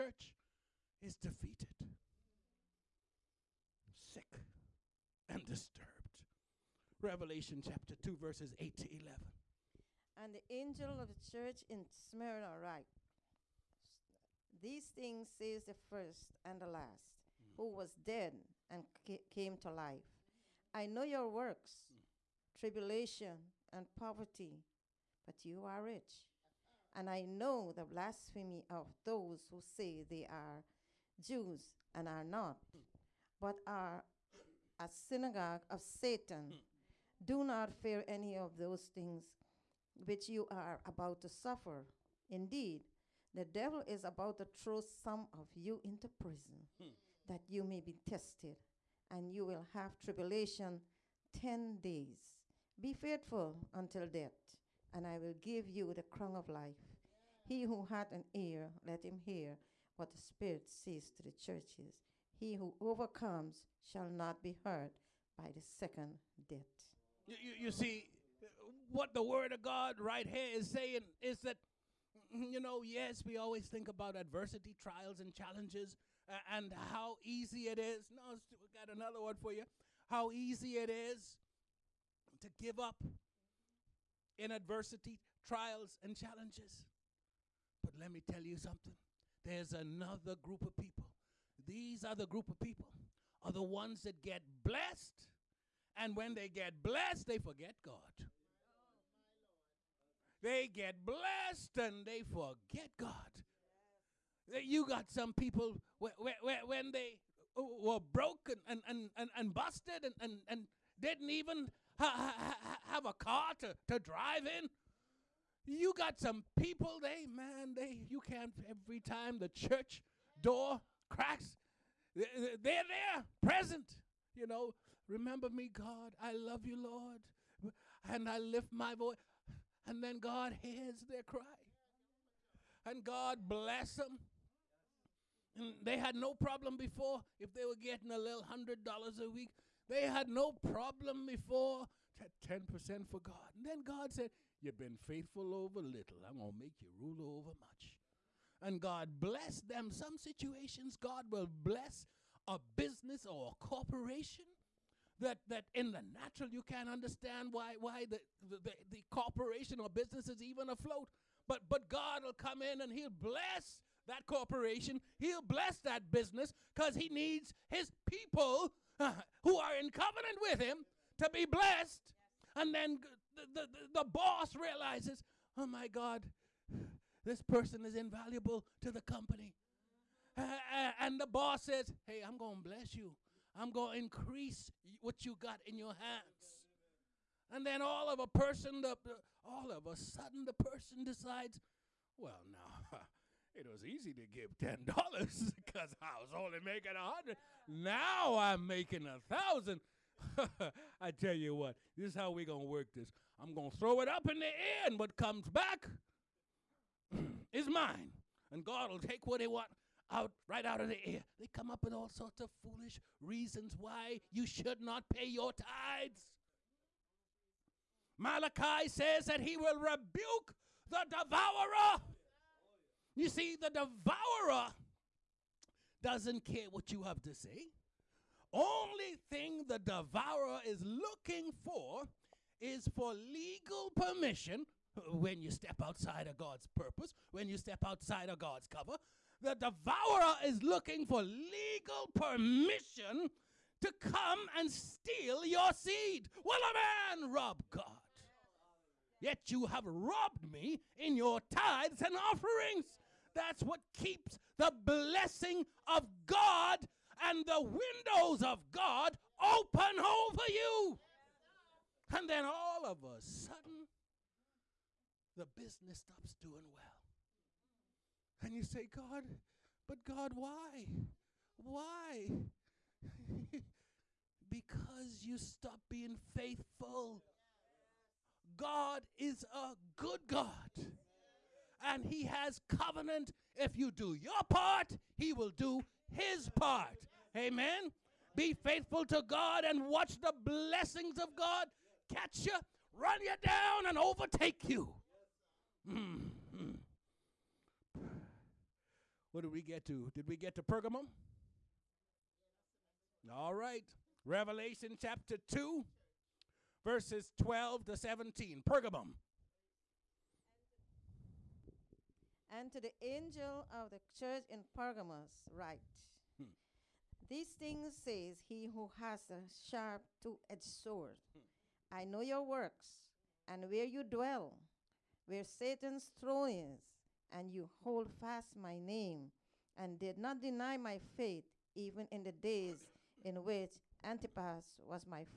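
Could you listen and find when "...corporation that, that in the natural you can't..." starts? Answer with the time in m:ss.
2:33.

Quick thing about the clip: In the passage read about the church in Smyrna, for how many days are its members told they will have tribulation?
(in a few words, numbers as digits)
10 days.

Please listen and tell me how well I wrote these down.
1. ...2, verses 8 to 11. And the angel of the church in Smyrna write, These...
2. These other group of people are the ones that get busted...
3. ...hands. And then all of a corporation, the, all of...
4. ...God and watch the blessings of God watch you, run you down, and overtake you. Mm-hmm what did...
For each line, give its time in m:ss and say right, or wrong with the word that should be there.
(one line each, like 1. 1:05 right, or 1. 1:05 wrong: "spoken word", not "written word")
1. 0:07 right
2. 1:31 wrong: "blessed", not "busted"
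3. 3:05 wrong: "person", not "corporation"
4. 4:49 wrong: "catch", not "watch".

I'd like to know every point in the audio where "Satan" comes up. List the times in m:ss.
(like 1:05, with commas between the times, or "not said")
0:35, 5:25.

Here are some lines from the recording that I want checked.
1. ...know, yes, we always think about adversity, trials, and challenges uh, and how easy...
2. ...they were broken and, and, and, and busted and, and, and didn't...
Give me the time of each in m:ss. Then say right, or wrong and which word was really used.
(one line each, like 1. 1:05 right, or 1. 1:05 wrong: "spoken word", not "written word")
1. 1:12 right
2. 1:46 right.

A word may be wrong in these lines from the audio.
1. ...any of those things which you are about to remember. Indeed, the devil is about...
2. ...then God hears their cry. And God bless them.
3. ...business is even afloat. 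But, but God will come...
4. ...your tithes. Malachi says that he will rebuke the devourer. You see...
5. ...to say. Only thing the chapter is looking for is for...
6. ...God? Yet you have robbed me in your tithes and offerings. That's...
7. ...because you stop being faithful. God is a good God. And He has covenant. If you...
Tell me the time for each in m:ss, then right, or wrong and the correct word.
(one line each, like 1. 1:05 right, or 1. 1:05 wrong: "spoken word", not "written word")
1. 0:38 wrong: "suffer", not "remember"
2. 2:10 right
3. 2:39 right
4. 3:35 right
5. 3:47 wrong: "devourer", not "chapter"
6. 4:07 right
7. 4:34 right.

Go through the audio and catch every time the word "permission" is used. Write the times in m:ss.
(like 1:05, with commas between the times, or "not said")
3:53, 4:02.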